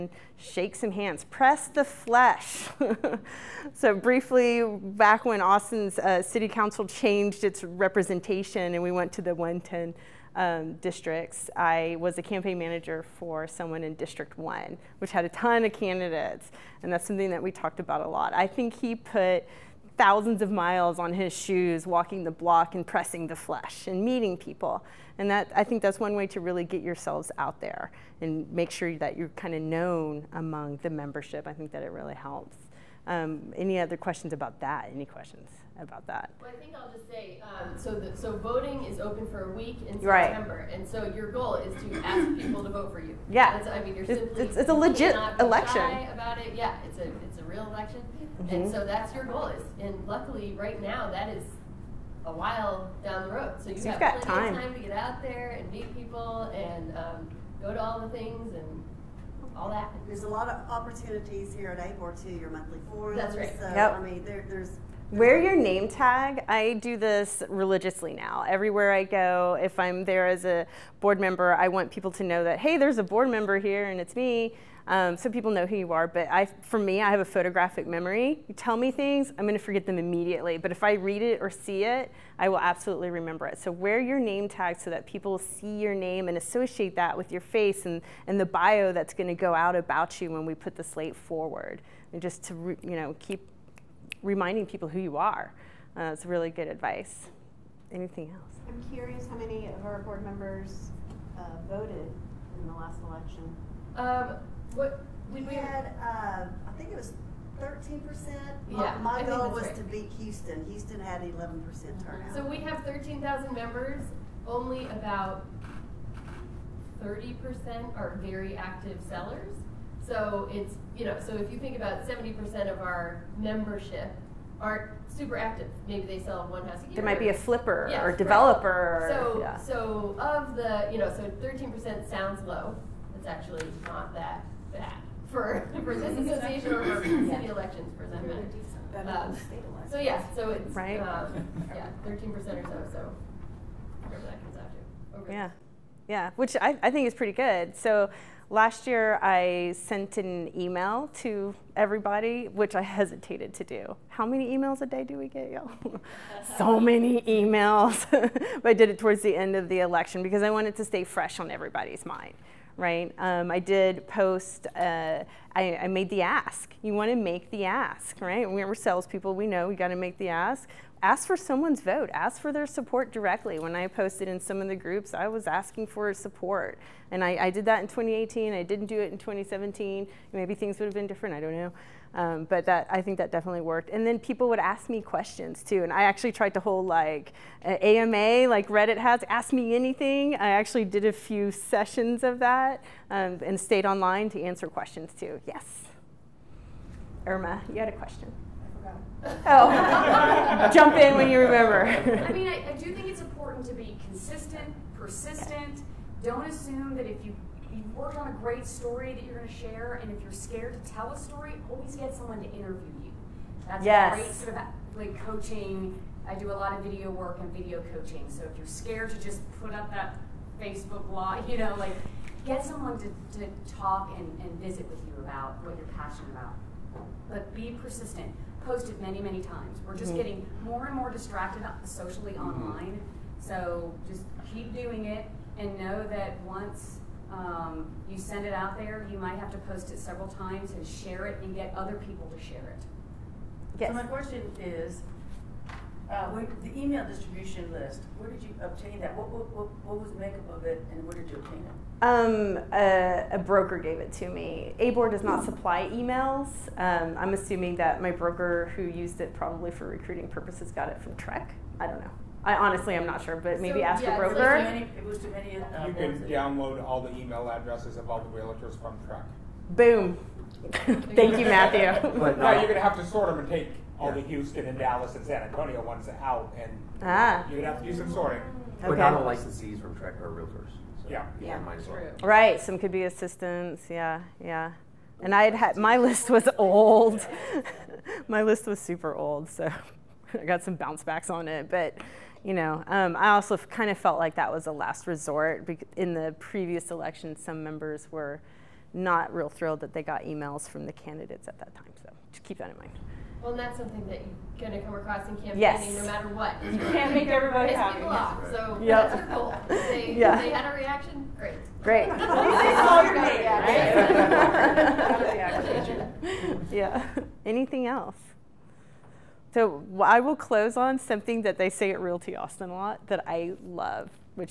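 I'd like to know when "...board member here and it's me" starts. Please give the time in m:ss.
1:13.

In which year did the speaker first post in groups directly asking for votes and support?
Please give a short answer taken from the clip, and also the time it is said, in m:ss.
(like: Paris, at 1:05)
2018, at 2:57.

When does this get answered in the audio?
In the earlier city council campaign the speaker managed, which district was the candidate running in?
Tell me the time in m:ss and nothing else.
0:13.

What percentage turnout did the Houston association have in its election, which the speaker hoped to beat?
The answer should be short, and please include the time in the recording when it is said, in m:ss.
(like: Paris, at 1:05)
11%, at 1:51.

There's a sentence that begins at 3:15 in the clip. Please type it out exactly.
Yes, Irma, you had a question.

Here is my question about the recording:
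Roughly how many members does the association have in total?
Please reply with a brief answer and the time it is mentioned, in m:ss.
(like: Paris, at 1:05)
13,000, at 1:52.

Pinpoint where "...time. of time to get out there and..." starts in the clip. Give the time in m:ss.
0:54.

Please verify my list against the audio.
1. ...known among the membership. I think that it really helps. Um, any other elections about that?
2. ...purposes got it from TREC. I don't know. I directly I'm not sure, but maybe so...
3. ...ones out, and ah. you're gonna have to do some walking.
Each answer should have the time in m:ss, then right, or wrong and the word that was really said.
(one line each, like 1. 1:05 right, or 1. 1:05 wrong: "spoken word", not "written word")
1. 0:29 wrong: "questions", not "elections"
2. 4:20 wrong: "honestly", not "directly"
3. 4:35 wrong: "sorting", not "walking".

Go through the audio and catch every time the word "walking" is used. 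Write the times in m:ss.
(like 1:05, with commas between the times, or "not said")
0:21.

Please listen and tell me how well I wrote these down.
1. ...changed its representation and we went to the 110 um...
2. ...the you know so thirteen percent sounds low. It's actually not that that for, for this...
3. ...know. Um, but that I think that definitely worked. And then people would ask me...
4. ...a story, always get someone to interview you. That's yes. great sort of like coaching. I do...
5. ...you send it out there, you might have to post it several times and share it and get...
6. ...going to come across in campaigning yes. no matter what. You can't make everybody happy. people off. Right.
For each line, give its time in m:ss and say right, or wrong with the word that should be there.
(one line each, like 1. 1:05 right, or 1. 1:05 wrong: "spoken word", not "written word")
1. 0:06 right
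2. 2:10 right
3. 3:01 right
4. 3:31 right
5. 3:58 right
6. 5:04 right.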